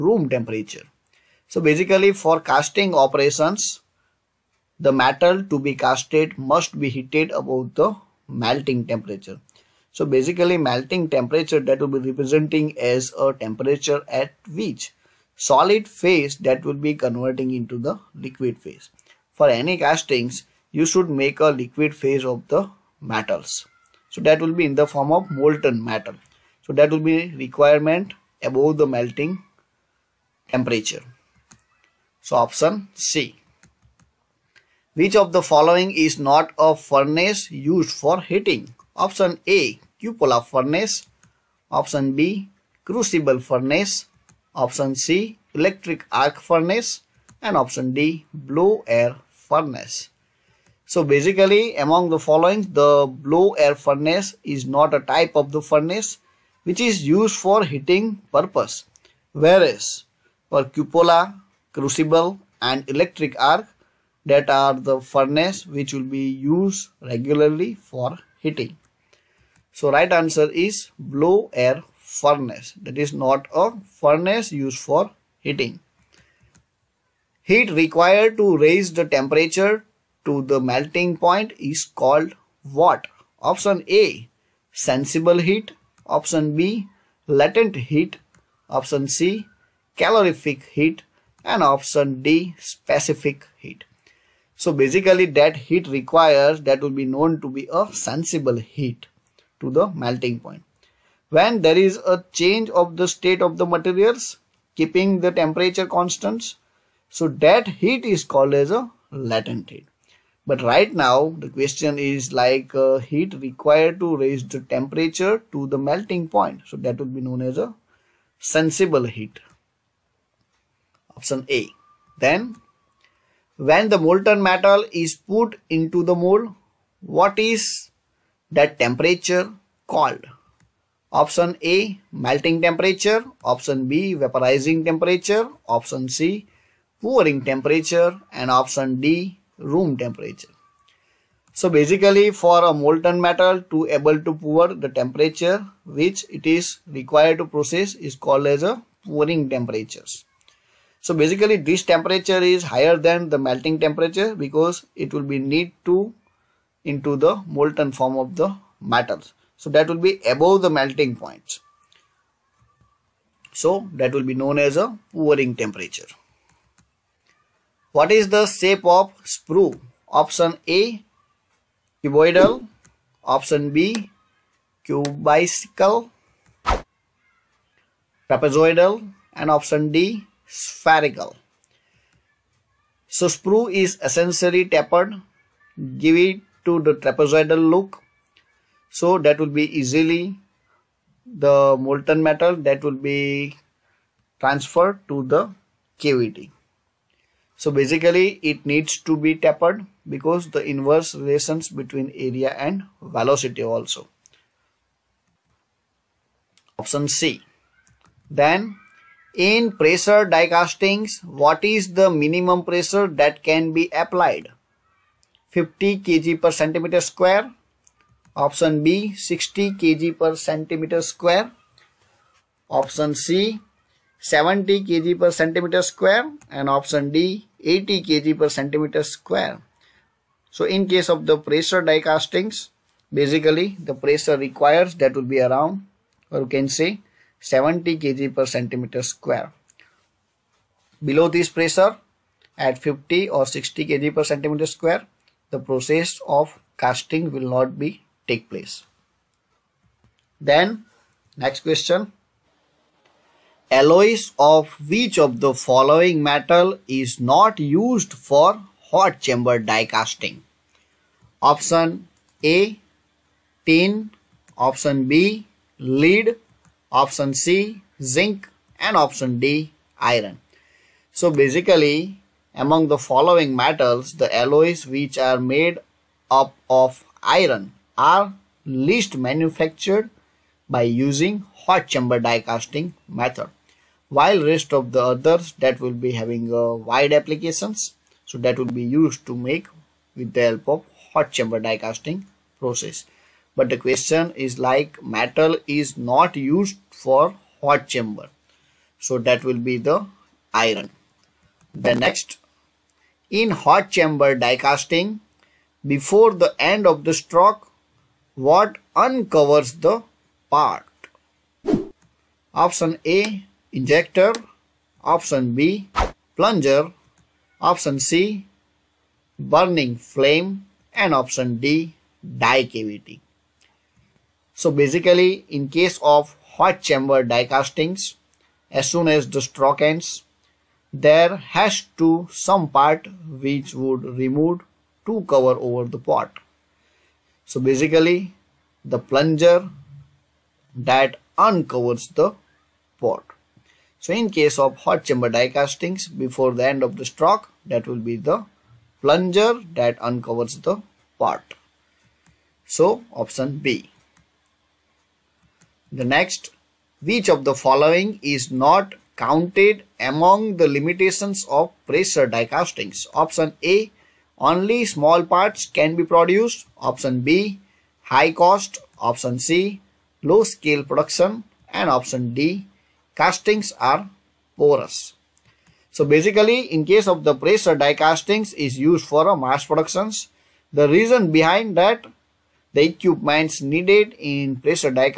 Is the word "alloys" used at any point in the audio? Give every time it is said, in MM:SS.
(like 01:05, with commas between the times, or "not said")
04:13, 04:34.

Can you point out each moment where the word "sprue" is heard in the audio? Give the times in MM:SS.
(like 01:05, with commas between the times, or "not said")
02:49, 03:03.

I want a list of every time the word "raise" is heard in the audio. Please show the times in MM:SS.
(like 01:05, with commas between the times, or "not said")
01:18, 01:54.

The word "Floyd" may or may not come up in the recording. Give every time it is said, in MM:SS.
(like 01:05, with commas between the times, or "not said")
not said.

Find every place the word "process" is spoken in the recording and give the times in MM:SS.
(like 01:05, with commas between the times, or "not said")
02:27, 04:05, 04:52.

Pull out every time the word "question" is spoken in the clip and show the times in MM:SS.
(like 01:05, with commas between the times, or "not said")
01:51, 04:11, 04:53.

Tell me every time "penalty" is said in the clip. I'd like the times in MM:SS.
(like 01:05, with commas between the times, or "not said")
not said.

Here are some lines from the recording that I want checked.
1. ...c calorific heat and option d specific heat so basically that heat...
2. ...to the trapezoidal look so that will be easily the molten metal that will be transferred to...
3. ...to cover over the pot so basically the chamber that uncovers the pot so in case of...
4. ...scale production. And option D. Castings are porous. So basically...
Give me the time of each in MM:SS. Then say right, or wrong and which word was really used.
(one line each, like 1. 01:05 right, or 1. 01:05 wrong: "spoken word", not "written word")
1. 01:29 right
2. 03:06 right
3. 05:35 wrong: "plunger", not "chamber"
4. 06:10 right.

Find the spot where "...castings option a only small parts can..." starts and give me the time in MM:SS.
06:02.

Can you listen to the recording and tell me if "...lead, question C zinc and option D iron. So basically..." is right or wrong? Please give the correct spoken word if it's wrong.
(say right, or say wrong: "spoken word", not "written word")
wrong: "option", not "question".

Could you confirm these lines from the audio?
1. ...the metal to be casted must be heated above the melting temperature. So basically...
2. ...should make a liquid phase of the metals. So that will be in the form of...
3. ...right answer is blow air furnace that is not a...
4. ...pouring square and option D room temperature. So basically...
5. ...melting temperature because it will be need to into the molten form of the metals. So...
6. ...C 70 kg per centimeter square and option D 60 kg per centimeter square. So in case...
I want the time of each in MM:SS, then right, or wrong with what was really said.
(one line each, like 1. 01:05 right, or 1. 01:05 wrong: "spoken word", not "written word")
1. 00:04 right
2. 00:20 right
3. 01:09 right
4. 02:17 wrong: "temperature", not "square"
5. 02:33 right
6. 03:43 wrong: "80", not "60".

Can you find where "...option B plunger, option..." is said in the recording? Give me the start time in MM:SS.
05:15.